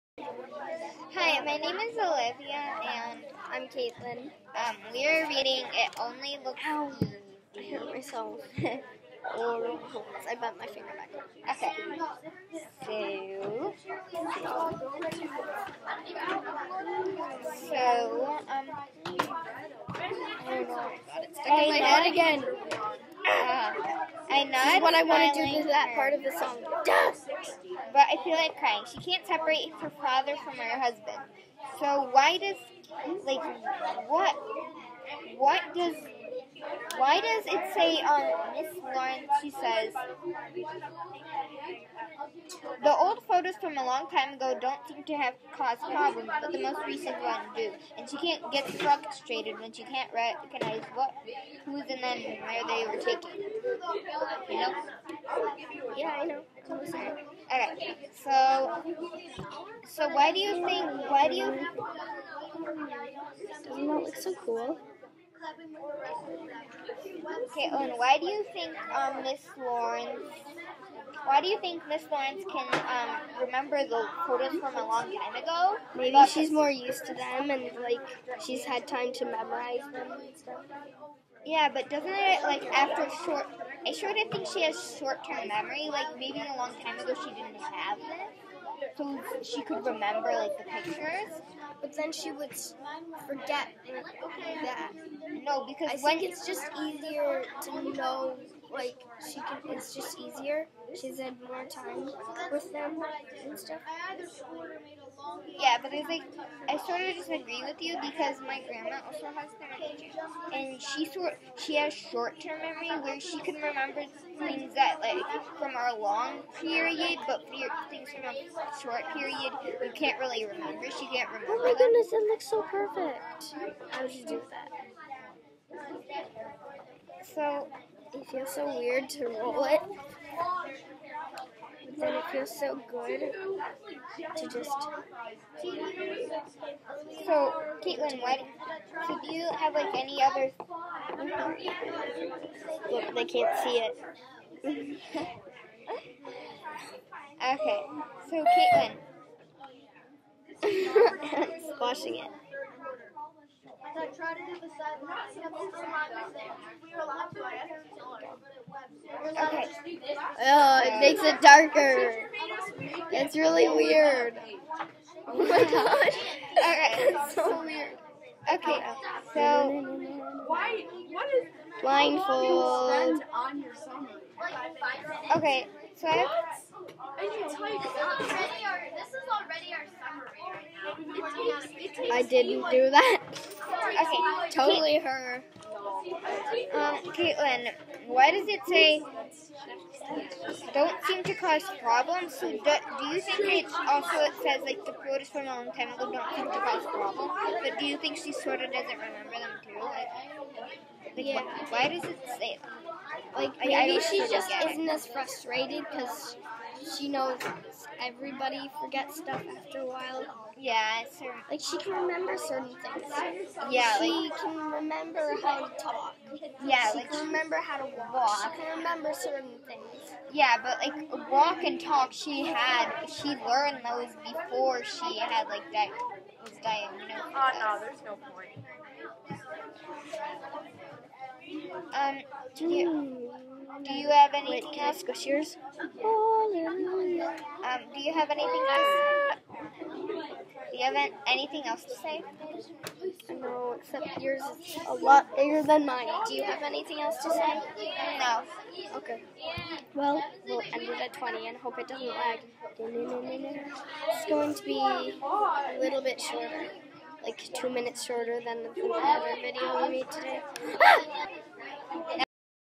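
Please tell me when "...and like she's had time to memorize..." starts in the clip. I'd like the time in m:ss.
1:17.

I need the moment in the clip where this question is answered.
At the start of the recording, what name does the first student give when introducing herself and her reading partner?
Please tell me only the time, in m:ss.
0:01.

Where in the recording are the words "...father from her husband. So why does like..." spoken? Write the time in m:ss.
0:30.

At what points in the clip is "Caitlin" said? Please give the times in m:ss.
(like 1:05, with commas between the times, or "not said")
0:03, 2:17, 2:30, 3:07.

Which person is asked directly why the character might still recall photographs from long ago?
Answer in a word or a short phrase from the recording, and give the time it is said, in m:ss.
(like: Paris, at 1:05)
Owen, at 1:07.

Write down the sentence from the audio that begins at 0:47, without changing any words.
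And she can't get frustrated when she can't recognize what, who's in them and where they were taken.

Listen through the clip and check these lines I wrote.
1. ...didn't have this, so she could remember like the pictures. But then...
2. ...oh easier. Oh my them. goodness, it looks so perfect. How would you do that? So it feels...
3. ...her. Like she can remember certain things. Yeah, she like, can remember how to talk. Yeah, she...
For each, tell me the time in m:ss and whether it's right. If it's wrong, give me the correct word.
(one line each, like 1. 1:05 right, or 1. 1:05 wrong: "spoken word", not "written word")
1. 1:27 right
2. 2:01 wrong: "remember", not "easier"
3. 3:31 right.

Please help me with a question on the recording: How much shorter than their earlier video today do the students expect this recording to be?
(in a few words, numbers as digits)
2 minutes.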